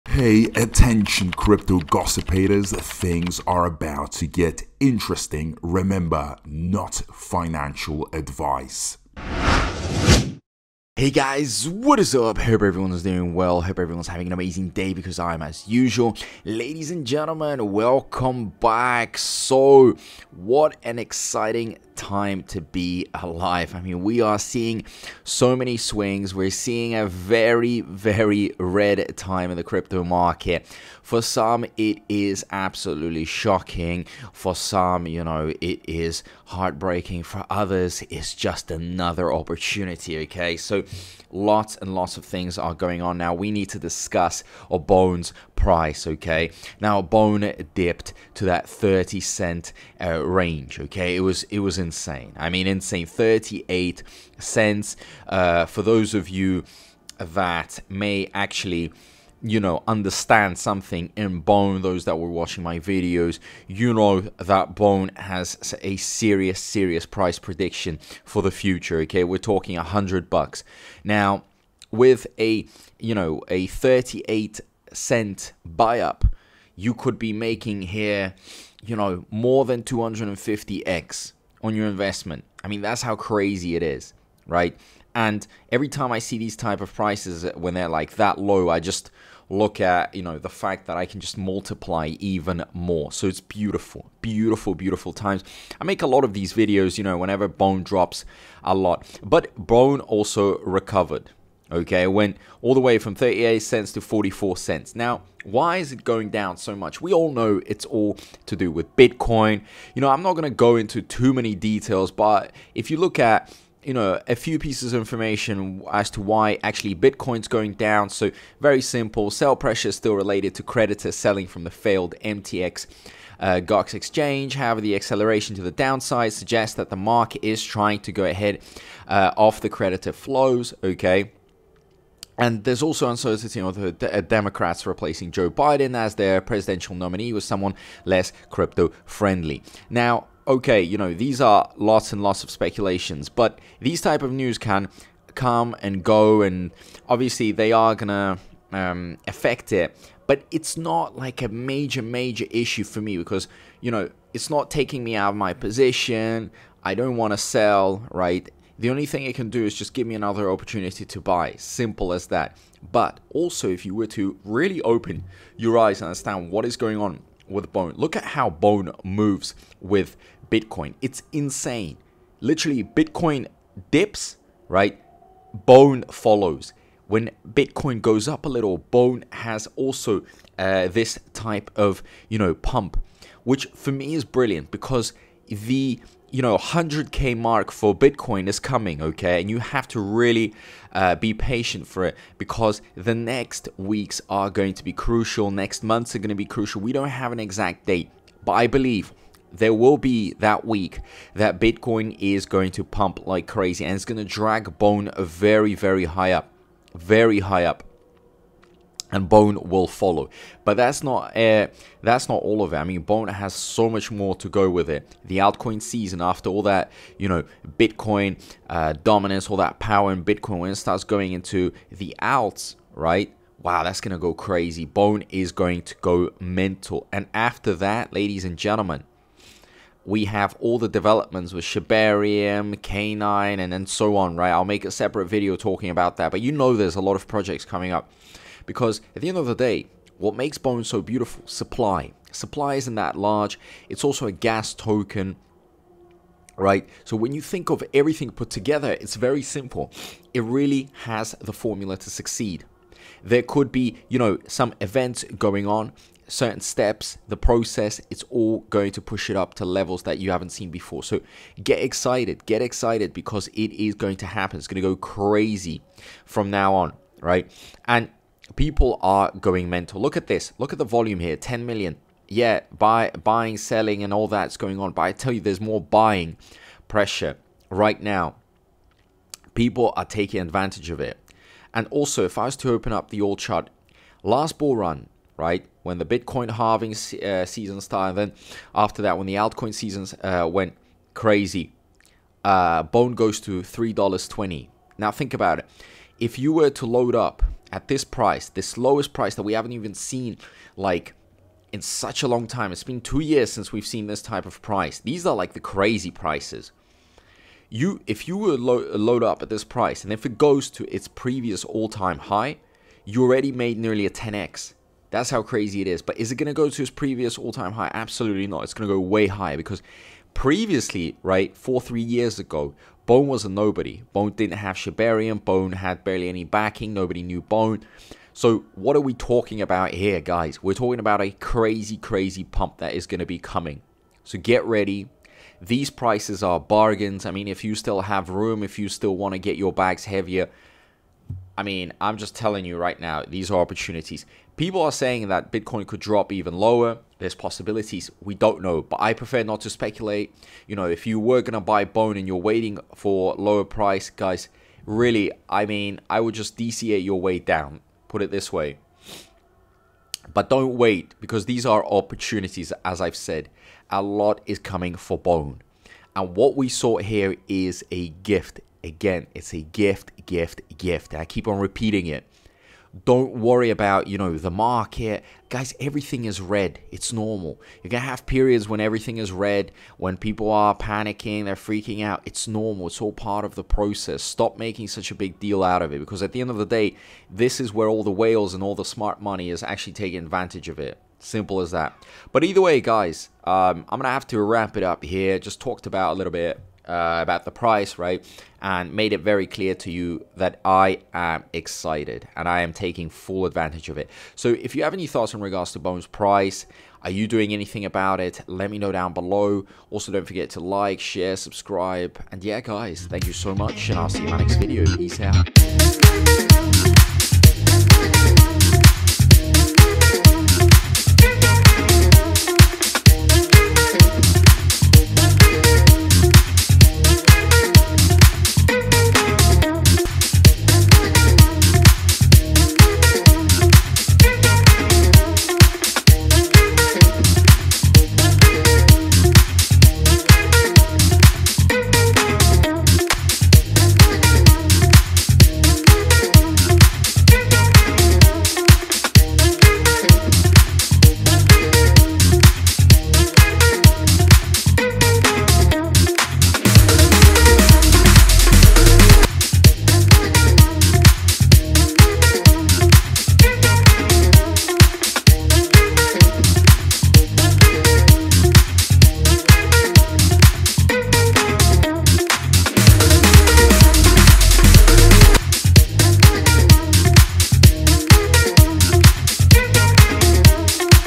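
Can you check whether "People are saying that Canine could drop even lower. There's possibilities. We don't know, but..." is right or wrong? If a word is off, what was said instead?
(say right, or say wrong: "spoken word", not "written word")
wrong: "Bitcoin", not "Canine".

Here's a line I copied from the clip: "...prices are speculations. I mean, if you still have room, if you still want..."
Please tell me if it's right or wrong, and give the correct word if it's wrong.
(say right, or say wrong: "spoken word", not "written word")
wrong: "bargains", not "speculations".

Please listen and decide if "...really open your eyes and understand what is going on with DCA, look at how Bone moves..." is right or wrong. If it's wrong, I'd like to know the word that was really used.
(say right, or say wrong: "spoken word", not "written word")
wrong: "Bone", not "DCA".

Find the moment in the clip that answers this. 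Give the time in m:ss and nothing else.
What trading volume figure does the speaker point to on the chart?
4:31.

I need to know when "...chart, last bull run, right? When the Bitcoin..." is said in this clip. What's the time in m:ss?
4:43.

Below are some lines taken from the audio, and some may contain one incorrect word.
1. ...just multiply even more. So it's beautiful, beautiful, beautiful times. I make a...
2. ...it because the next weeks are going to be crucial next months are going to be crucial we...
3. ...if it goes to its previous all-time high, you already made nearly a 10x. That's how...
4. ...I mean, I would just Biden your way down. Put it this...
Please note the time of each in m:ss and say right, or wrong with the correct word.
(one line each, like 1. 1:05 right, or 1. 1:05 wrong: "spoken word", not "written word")
1. 1:31 right
2. 3:12 right
3. 5:10 right
4. 5:55 wrong: "DCA", not "Biden".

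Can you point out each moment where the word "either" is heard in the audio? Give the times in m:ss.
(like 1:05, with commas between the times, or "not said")
6:32.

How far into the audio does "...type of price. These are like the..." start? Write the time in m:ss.
5:04.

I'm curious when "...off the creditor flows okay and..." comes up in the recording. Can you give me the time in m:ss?
2:09.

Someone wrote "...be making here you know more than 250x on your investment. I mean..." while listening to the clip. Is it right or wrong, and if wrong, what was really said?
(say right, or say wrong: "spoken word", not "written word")
right.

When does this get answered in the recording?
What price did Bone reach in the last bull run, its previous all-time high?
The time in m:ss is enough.
4:53.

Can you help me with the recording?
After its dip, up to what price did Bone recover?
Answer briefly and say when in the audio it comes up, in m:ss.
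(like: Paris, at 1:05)
44 cents, at 1:44.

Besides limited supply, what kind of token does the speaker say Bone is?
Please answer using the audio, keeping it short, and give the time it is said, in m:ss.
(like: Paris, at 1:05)
gas token, at 4:04.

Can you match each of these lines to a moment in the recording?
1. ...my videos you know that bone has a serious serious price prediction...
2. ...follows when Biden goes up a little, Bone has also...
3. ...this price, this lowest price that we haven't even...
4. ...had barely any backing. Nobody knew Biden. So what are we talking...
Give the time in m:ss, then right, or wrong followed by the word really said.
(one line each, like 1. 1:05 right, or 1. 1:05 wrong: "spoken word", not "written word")
1. 1:02 right
2. 2:56 wrong: "Bitcoin", not "Biden"
3. 4:57 right
4. 5:25 wrong: "Bone", not "Biden".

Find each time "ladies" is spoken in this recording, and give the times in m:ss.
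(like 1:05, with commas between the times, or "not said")
0:16, 3:48.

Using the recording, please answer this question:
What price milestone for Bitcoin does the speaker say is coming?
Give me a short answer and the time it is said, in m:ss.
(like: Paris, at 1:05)
100k, at 3:06.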